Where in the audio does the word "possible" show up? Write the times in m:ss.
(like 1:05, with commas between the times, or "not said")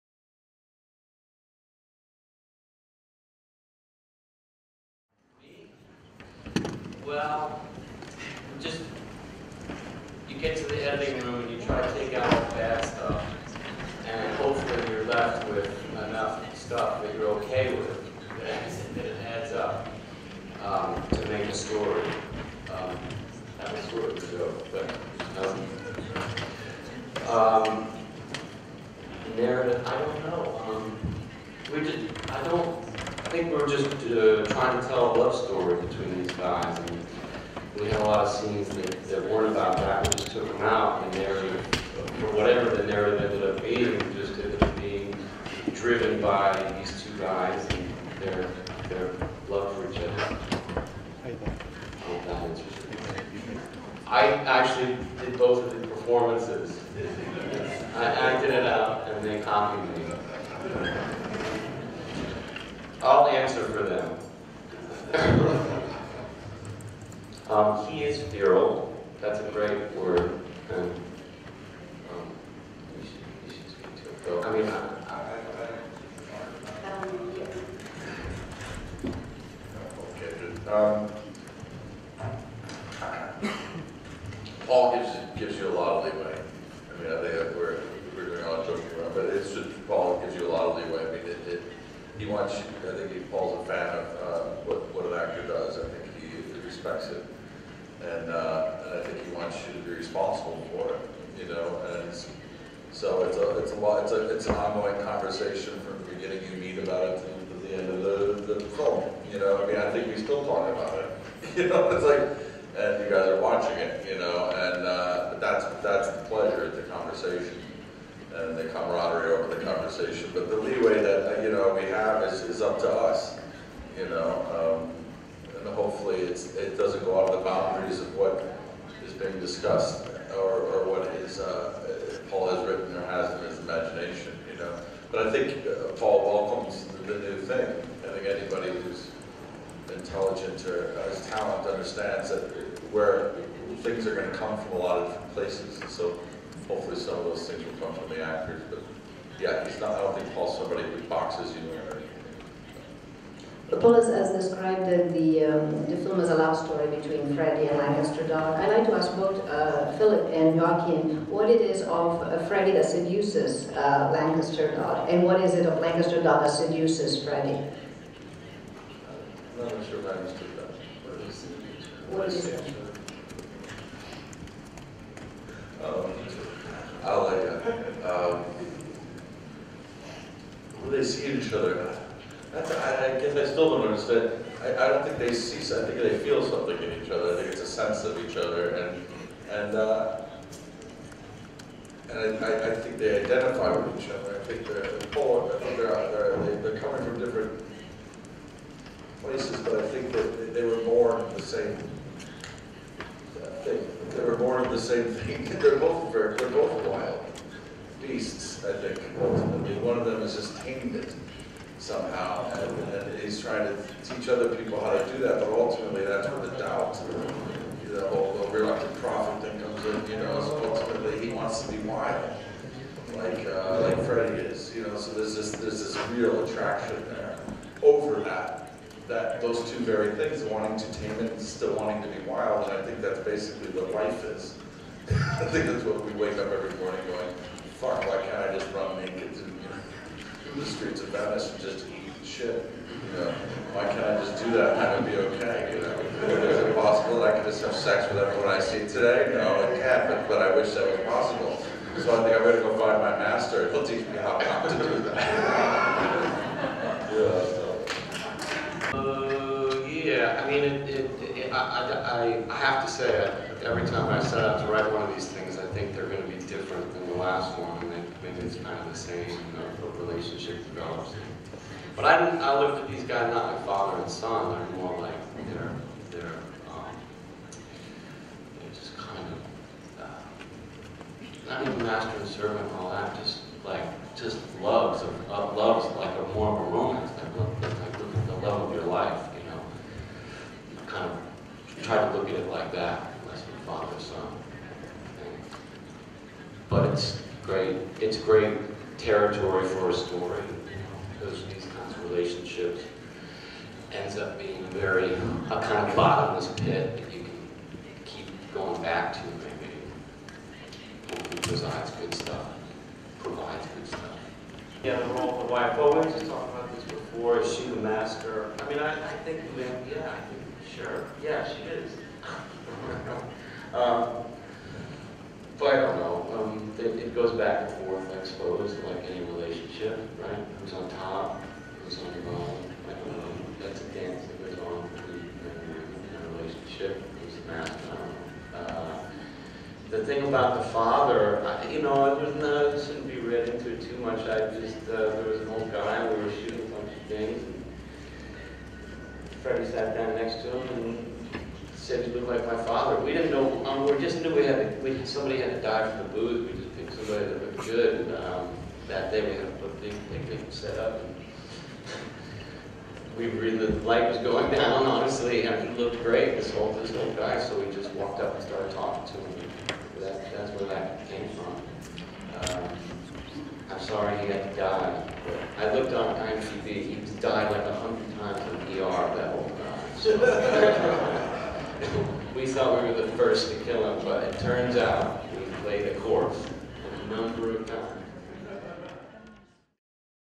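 4:06, 4:11.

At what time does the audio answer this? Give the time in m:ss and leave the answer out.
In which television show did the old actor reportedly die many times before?
6:18.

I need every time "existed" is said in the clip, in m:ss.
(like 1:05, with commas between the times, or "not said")
not said.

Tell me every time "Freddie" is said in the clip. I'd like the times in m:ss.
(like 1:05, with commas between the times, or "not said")
2:37, 2:42, 2:47, 3:44, 5:49.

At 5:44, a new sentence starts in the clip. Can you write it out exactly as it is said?
I just, uh, there was an old guy, we were shooting a bunch of things.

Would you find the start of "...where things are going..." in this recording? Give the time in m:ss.
2:22.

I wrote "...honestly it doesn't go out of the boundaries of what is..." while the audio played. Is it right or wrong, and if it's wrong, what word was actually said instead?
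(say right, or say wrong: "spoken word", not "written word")
wrong: "hopefully", not "honestly".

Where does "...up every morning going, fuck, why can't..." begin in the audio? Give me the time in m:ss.
3:56.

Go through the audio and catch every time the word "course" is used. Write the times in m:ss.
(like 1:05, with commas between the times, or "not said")
6:26.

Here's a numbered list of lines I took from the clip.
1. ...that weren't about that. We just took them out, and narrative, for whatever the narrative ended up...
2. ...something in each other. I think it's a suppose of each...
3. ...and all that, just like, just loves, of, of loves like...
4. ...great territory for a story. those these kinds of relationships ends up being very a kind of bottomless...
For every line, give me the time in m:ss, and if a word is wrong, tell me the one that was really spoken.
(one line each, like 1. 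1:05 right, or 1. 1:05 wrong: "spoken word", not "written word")
1. 0:39 right
2. 3:06 wrong: "sense", not "suppose"
3. 4:42 right
4. 4:58 right.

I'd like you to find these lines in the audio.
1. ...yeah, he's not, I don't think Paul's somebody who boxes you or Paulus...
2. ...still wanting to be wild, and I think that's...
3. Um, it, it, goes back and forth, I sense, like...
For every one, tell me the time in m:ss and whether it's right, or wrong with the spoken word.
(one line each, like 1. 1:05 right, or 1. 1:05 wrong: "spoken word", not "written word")
1. 2:29 right
2. 3:51 right
3. 5:26 wrong: "suppose", not "sense".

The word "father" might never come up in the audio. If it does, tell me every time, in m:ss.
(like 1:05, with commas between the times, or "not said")
4:33, 4:53, 5:40, 5:52.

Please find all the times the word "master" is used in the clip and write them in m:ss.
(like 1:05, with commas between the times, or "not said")
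4:13, 4:41, 5:17, 5:37.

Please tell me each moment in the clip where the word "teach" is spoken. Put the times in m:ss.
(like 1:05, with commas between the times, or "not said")
3:34, 4:13.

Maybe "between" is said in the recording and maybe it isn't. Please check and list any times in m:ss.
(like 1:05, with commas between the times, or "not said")
0:35, 2:36.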